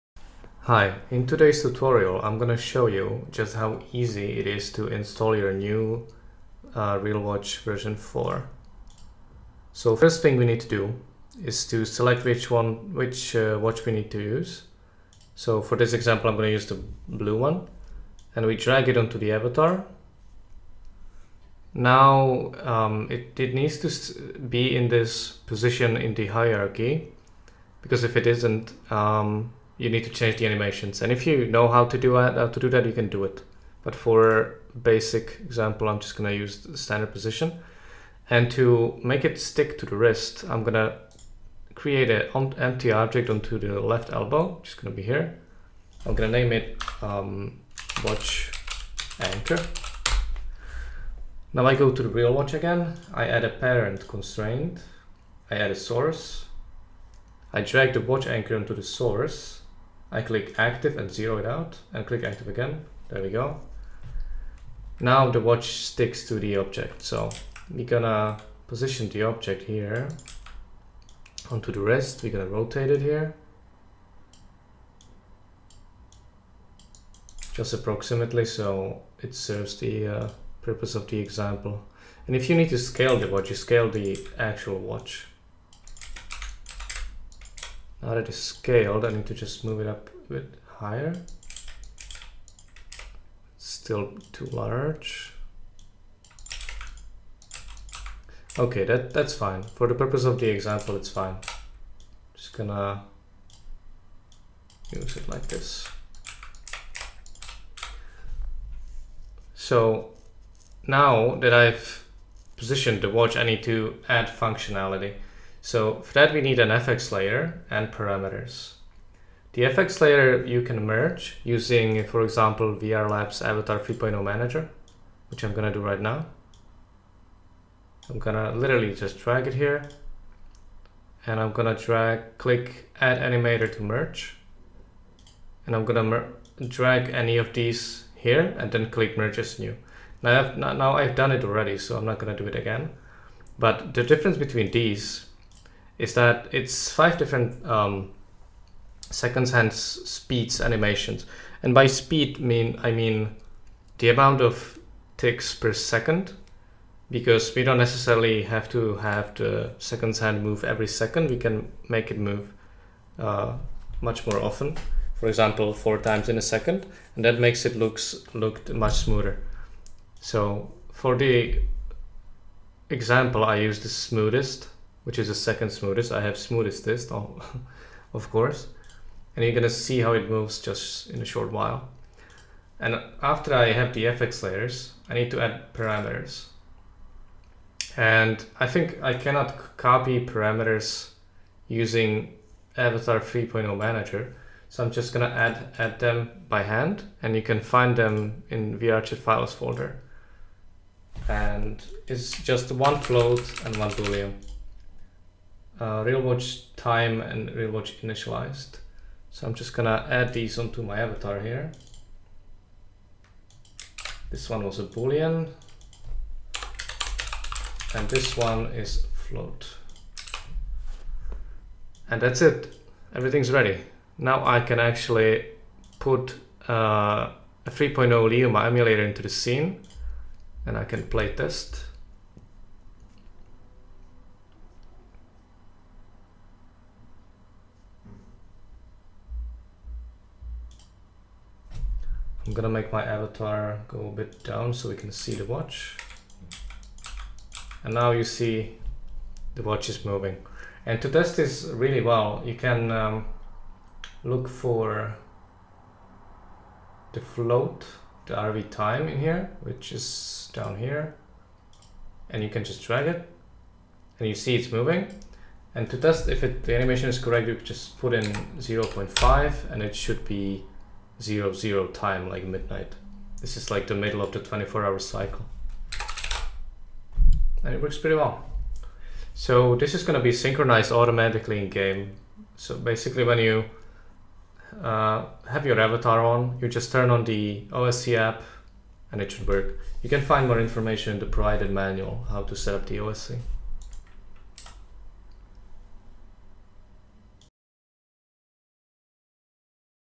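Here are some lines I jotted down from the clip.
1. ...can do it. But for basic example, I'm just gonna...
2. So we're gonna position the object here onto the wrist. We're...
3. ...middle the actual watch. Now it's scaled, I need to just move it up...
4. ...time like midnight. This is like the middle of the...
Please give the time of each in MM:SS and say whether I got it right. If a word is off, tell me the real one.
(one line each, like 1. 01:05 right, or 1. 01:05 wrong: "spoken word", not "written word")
1. 00:32 right
2. 01:07 right
3. 01:23 wrong: "scale", not "middle"
4. 04:31 right.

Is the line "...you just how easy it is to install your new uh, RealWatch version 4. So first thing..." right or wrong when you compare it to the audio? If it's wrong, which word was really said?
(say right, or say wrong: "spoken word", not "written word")
right.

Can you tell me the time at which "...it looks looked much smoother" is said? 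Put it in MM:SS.
02:47.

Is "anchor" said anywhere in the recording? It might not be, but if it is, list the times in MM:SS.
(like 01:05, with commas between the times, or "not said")
00:49, 00:58.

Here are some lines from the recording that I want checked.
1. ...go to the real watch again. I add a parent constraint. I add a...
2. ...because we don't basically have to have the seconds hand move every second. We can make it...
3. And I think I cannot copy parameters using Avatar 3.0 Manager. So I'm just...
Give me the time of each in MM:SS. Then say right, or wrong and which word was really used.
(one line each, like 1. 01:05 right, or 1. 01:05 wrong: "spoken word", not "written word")
1. 00:51 right
2. 02:37 wrong: "necessarily", not "basically"
3. 03:07 right.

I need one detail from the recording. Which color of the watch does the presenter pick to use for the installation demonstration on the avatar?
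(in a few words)
Blue.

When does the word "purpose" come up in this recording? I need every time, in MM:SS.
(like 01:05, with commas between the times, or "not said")
01:20, 01:39.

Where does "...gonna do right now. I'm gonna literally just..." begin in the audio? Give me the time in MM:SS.
02:05.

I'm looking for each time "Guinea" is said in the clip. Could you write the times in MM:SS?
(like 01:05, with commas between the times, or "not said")
not said.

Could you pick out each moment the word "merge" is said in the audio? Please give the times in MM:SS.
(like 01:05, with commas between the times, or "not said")
02:00, 02:13, 02:19.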